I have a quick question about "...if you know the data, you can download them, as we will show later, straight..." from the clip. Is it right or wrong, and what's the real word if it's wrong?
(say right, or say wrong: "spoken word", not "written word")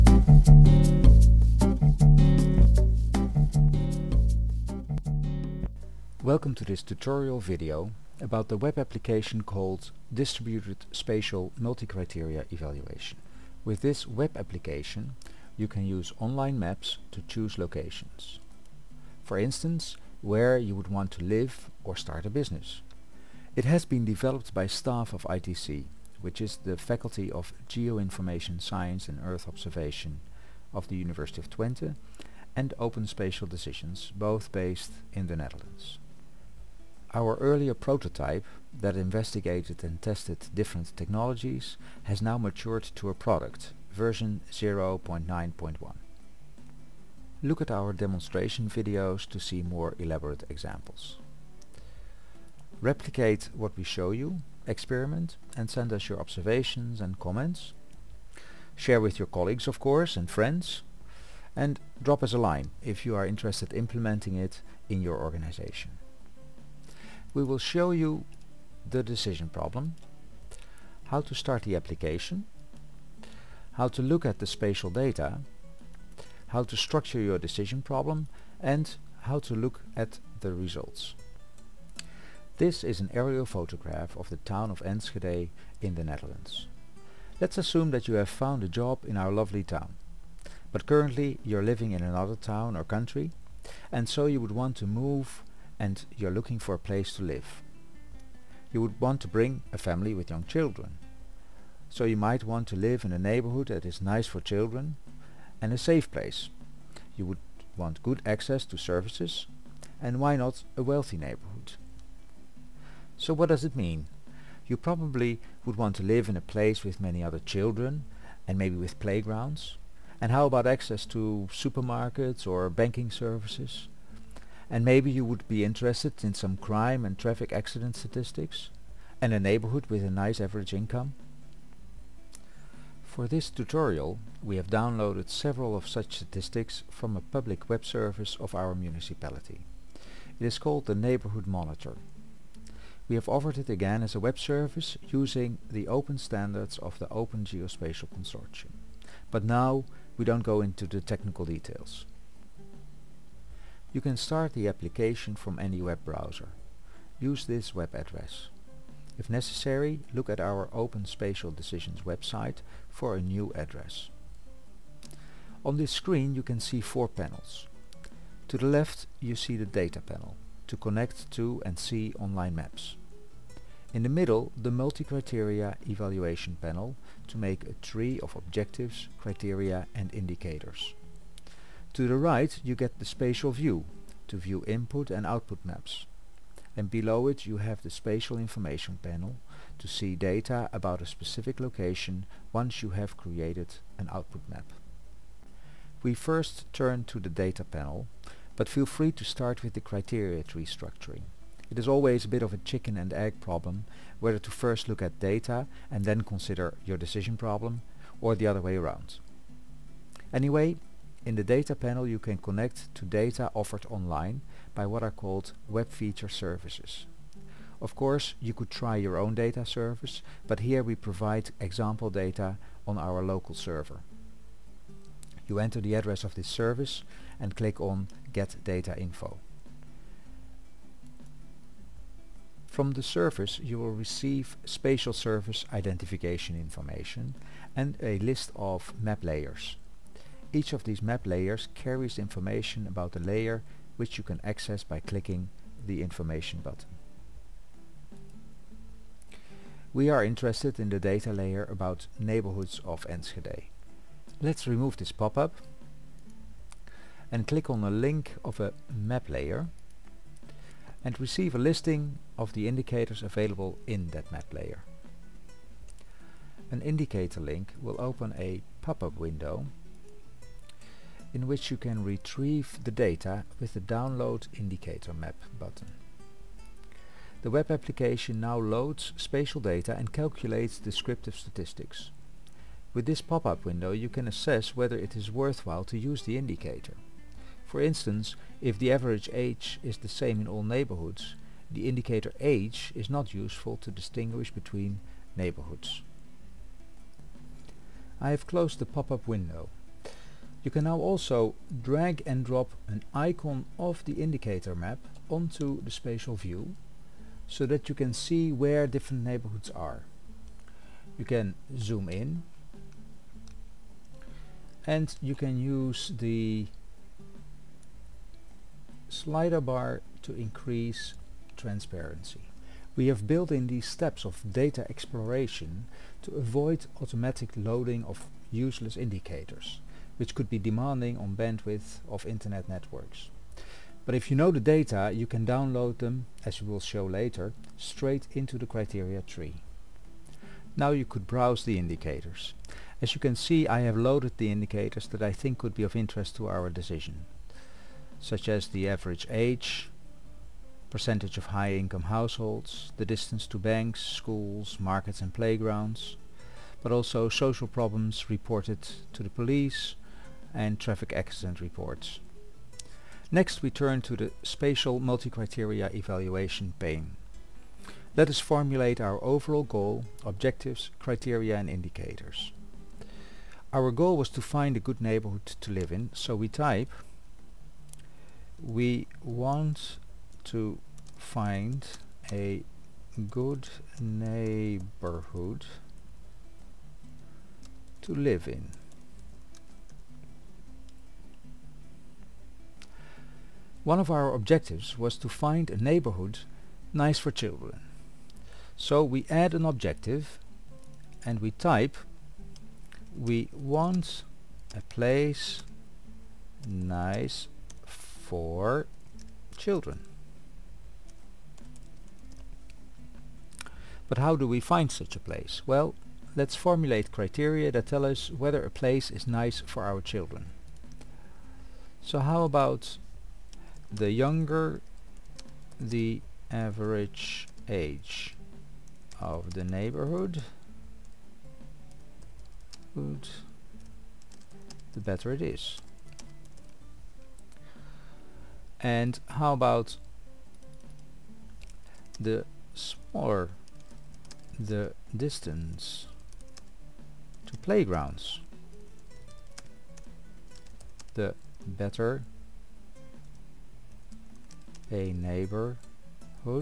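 right.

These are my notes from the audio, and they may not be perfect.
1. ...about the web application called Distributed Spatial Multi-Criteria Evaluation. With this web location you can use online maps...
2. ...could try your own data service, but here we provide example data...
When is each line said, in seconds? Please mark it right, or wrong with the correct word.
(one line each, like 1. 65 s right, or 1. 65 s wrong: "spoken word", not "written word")
1. 8 s wrong: "application", not "location"
2. 218 s right.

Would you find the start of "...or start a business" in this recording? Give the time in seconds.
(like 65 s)
21 s.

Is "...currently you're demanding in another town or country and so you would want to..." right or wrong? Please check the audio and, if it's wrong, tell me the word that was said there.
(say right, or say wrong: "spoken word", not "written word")
wrong: "living", not "demanding".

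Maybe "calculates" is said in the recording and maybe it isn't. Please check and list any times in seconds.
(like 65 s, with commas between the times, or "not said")
280 s.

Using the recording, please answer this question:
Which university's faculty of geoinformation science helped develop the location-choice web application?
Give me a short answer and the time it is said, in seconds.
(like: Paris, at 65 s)
University of Twente, at 30 s.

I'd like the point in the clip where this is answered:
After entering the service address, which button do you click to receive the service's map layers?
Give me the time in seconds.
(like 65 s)
228 s.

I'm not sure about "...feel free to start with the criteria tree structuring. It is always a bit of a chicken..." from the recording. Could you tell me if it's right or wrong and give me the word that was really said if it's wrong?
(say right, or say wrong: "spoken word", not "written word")
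right.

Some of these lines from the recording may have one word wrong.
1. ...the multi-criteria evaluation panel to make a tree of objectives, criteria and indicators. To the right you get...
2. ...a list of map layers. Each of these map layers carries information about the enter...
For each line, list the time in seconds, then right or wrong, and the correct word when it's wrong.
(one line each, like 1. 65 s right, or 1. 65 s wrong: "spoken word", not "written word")
1. 174 s right
2. 238 s wrong: "layer", not "enter".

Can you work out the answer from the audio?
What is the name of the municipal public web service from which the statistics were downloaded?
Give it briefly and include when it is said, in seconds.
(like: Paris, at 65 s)
Neighborhood Monitor, at 140 s.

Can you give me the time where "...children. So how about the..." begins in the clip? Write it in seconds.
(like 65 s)
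420 s.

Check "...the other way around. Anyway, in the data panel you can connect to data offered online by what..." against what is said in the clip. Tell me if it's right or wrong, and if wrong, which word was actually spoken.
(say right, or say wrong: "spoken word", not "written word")
right.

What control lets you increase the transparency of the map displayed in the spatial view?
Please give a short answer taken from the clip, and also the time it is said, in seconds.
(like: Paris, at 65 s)
slider bar, at 319 s.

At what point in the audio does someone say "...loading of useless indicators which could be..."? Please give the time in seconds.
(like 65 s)
327 s.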